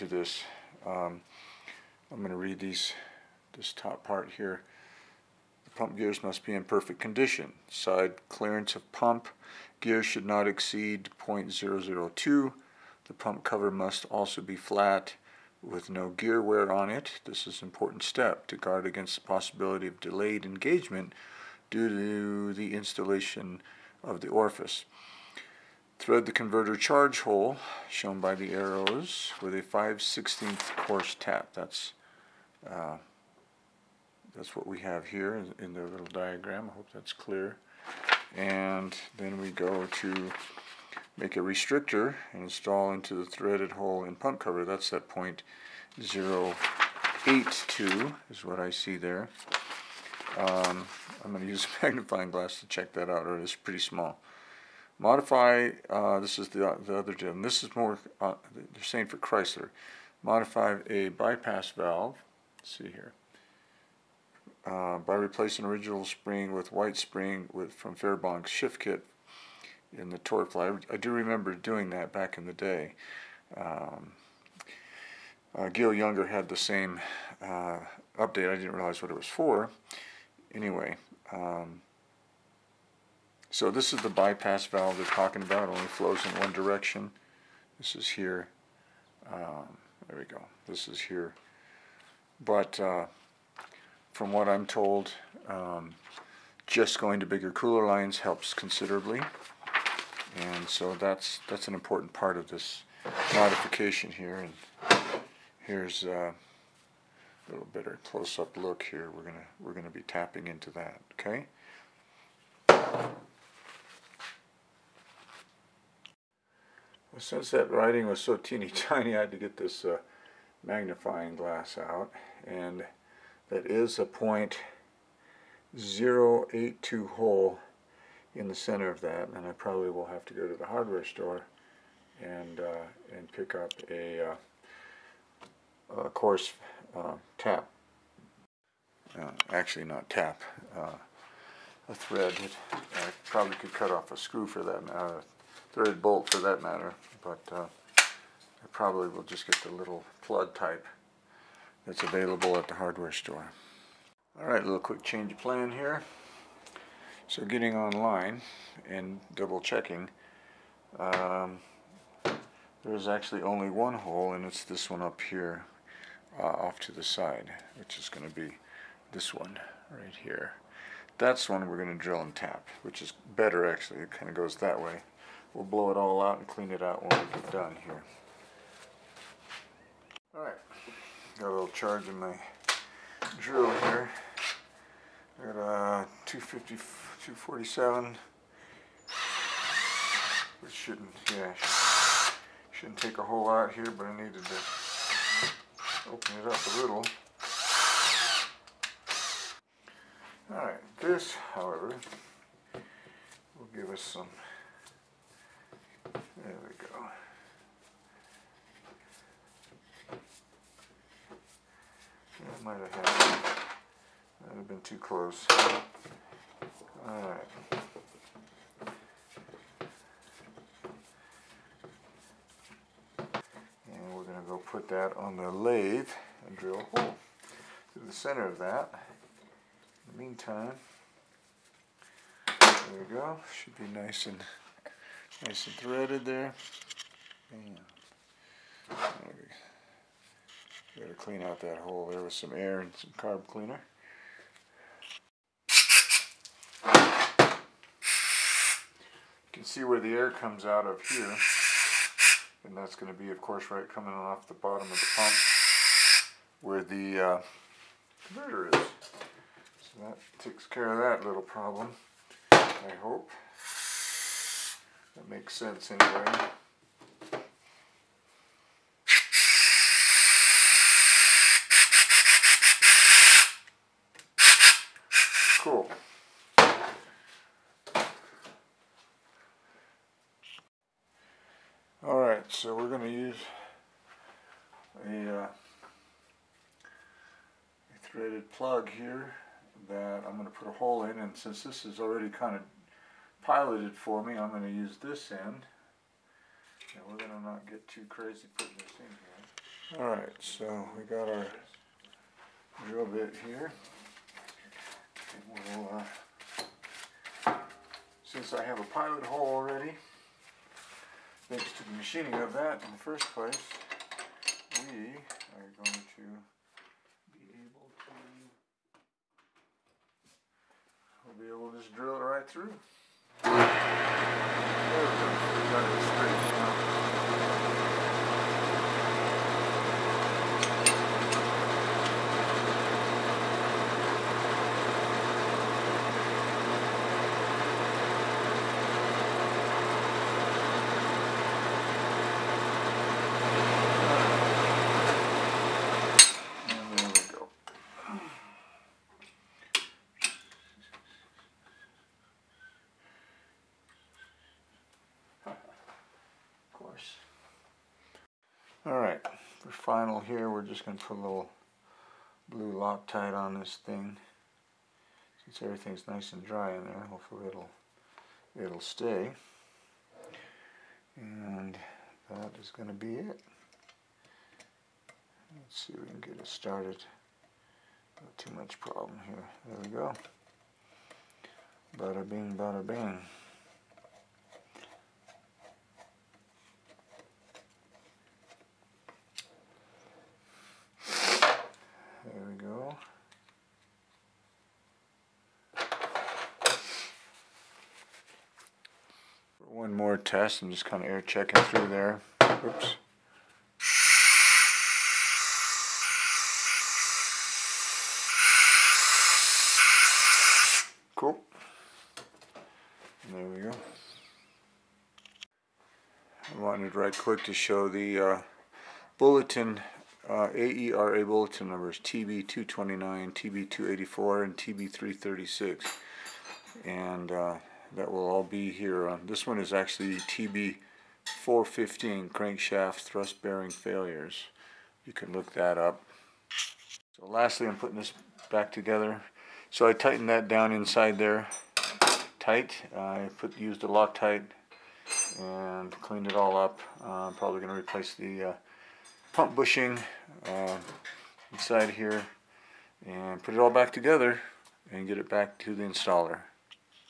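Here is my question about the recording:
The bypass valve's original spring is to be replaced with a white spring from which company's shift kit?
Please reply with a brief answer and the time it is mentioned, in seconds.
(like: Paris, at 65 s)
Fairbank's, at 67 s.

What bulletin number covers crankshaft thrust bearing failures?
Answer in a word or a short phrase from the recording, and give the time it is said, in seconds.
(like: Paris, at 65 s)
TB415, at 430 s.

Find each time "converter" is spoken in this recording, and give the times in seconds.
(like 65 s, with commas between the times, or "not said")
26 s, 258 s.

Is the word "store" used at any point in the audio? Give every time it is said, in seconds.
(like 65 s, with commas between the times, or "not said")
131 s, 153 s.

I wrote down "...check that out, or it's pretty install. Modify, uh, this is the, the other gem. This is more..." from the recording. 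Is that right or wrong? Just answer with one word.
wrong.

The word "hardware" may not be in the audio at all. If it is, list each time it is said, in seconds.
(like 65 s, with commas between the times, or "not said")
130 s, 152 s.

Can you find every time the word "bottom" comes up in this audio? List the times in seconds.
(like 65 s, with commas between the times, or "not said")
254 s.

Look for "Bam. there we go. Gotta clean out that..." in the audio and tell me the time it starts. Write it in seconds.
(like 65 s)
237 s.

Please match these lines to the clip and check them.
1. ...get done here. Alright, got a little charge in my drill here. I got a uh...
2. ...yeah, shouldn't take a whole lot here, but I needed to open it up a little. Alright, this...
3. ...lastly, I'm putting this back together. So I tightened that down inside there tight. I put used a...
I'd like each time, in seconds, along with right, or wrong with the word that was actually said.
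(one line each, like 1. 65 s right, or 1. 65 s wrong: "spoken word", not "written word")
1. 177 s right
2. 191 s right
3. 437 s right.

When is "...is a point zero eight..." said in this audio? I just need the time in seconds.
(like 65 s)
123 s.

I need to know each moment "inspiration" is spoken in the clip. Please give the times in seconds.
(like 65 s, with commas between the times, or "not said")
not said.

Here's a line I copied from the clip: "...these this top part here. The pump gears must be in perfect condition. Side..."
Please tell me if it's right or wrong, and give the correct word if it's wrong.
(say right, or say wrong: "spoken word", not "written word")
right.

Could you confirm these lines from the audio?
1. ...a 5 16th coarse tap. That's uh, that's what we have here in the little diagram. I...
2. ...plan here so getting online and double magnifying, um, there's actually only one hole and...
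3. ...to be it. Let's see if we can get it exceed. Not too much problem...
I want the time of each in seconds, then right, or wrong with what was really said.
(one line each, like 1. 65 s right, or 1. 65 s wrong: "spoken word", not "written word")
1. 29 s right
2. 155 s wrong: "checking", not "magnifying"
3. 372 s wrong: "started", not "exceed".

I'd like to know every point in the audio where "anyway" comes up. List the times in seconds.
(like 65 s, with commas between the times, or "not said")
80 s, 265 s.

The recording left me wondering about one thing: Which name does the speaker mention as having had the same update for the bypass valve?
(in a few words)
Gil Younger.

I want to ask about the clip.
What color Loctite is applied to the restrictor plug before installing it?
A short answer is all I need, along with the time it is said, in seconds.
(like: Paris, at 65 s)
Blue, at 362 s.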